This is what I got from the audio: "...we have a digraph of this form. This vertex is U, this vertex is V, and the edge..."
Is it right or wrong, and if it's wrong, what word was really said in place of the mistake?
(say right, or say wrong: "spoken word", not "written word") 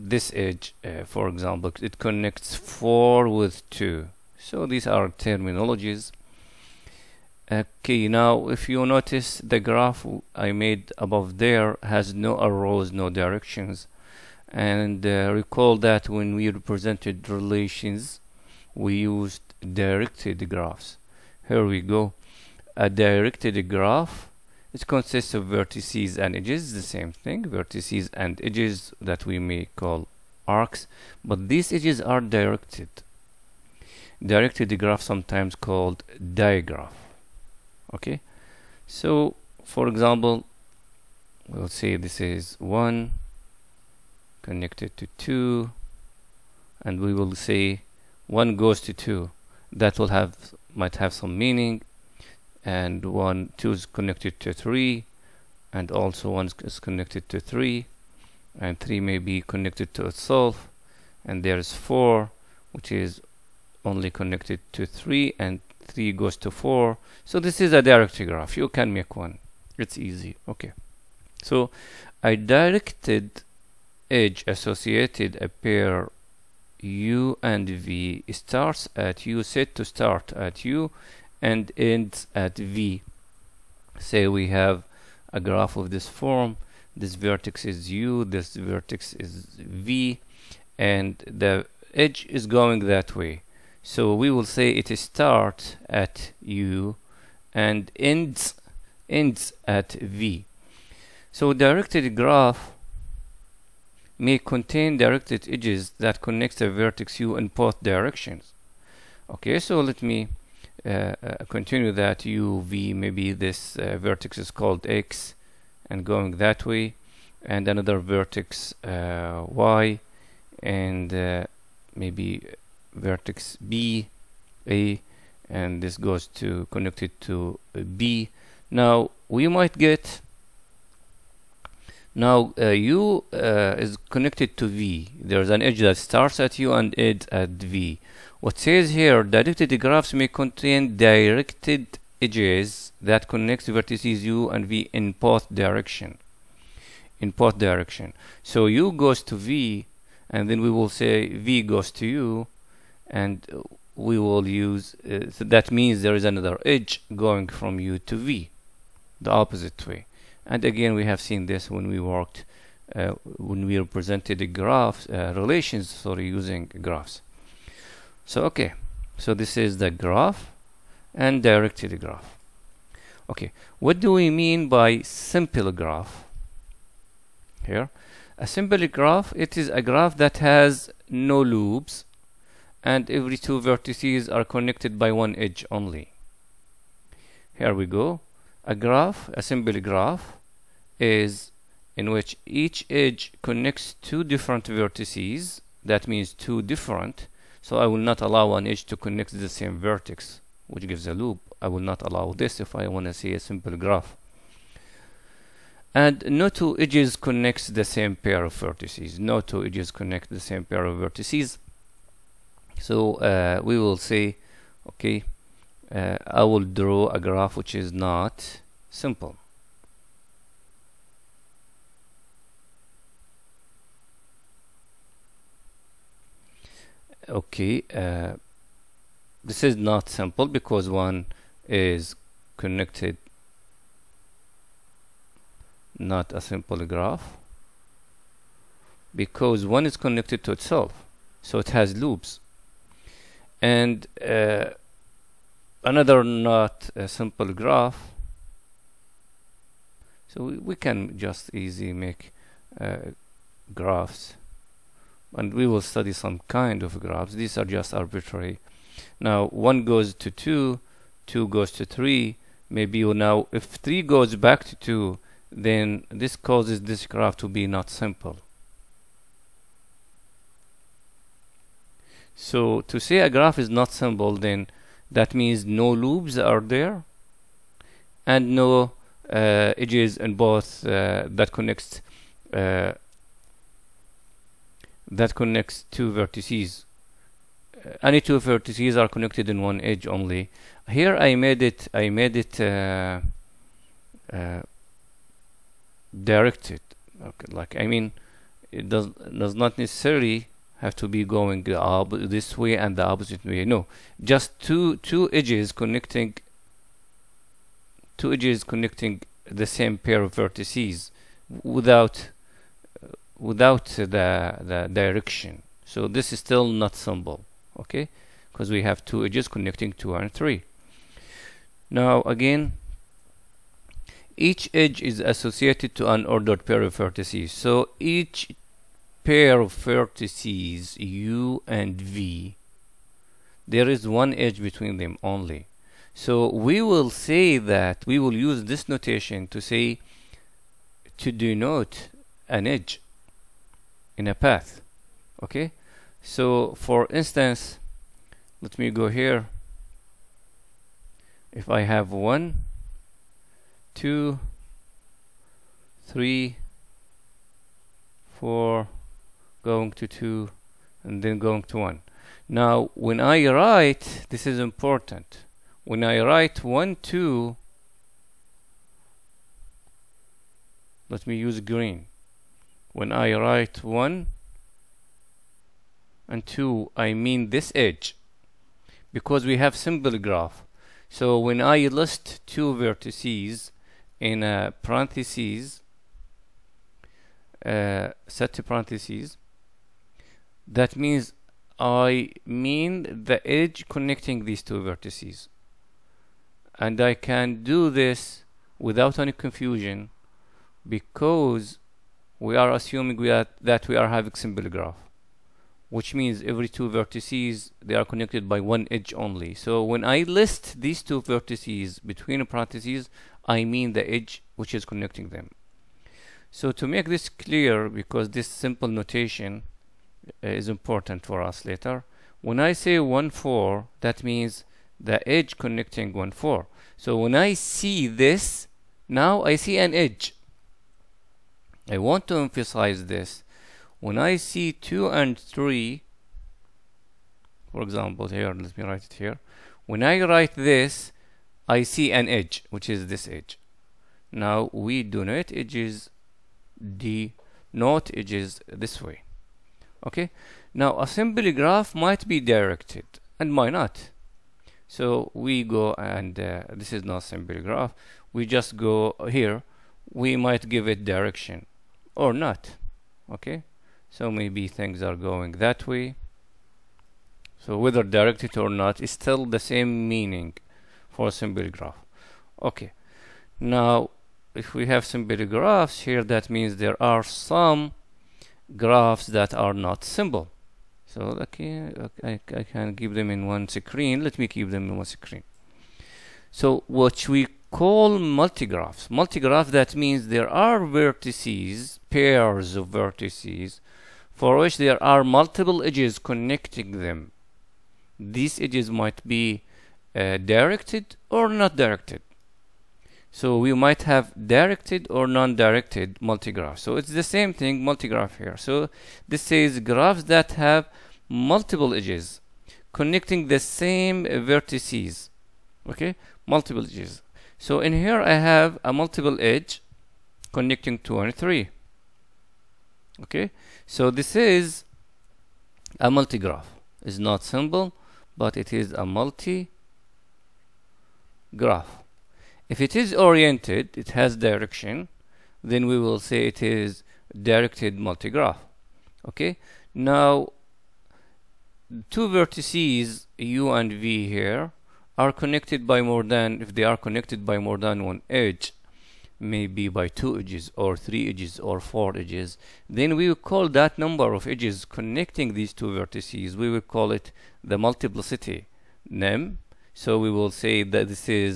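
wrong: "graph", not "digraph".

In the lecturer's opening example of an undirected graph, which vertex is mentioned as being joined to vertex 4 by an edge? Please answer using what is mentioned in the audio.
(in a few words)
2.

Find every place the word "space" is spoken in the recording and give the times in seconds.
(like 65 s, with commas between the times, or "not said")
not said.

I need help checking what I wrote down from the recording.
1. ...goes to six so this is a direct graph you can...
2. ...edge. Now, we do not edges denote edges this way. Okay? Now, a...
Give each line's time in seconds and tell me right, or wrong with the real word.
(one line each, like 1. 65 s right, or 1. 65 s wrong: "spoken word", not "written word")
1. 66 s wrong: "four", not "six"
2. 443 s right.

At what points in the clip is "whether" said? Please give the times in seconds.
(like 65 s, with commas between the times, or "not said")
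467 s.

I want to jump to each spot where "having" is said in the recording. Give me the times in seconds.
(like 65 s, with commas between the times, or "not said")
404 s.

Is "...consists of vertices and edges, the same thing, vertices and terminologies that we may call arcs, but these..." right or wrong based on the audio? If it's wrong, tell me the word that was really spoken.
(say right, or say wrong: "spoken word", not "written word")
wrong: "edges", not "terminologies".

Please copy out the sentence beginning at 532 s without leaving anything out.
If it is oriented, it has direction, then we will say it is directed multigraph.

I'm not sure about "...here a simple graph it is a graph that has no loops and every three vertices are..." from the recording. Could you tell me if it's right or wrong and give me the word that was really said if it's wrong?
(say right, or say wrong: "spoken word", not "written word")
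wrong: "two", not "three".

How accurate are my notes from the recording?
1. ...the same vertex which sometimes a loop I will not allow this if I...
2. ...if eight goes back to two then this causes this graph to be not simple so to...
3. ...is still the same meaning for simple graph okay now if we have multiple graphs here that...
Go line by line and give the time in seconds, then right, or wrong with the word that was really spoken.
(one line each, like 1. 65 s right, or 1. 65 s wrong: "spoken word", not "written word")
1. 199 s wrong: "gives", not "sometimes"
2. 263 s wrong: "three", not "eight"
3. 468 s wrong: "simple", not "multiple".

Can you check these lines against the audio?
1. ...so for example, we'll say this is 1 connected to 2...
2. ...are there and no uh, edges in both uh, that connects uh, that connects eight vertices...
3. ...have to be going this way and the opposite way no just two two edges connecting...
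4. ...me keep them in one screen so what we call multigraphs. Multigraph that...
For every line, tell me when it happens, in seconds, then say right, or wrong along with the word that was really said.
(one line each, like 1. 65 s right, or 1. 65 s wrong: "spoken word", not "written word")
1. 38 s right
2. 276 s wrong: "two", not "eight"
3. 300 s right
4. 484 s right.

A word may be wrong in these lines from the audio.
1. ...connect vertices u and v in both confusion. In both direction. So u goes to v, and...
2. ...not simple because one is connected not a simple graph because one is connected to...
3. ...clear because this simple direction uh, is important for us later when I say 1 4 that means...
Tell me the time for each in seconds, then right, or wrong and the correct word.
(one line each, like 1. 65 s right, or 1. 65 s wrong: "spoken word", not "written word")
1. 143 s wrong: "direction", not "confusion"
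2. 229 s right
3. 417 s wrong: "notation", not "direction".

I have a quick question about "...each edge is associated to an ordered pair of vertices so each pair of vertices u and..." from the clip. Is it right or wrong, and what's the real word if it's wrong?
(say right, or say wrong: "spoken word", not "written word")
right.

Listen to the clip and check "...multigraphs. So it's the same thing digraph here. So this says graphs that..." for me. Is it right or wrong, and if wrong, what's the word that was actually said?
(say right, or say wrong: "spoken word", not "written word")
wrong: "multigraph", not "digraph".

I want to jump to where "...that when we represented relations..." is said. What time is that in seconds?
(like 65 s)
15 s.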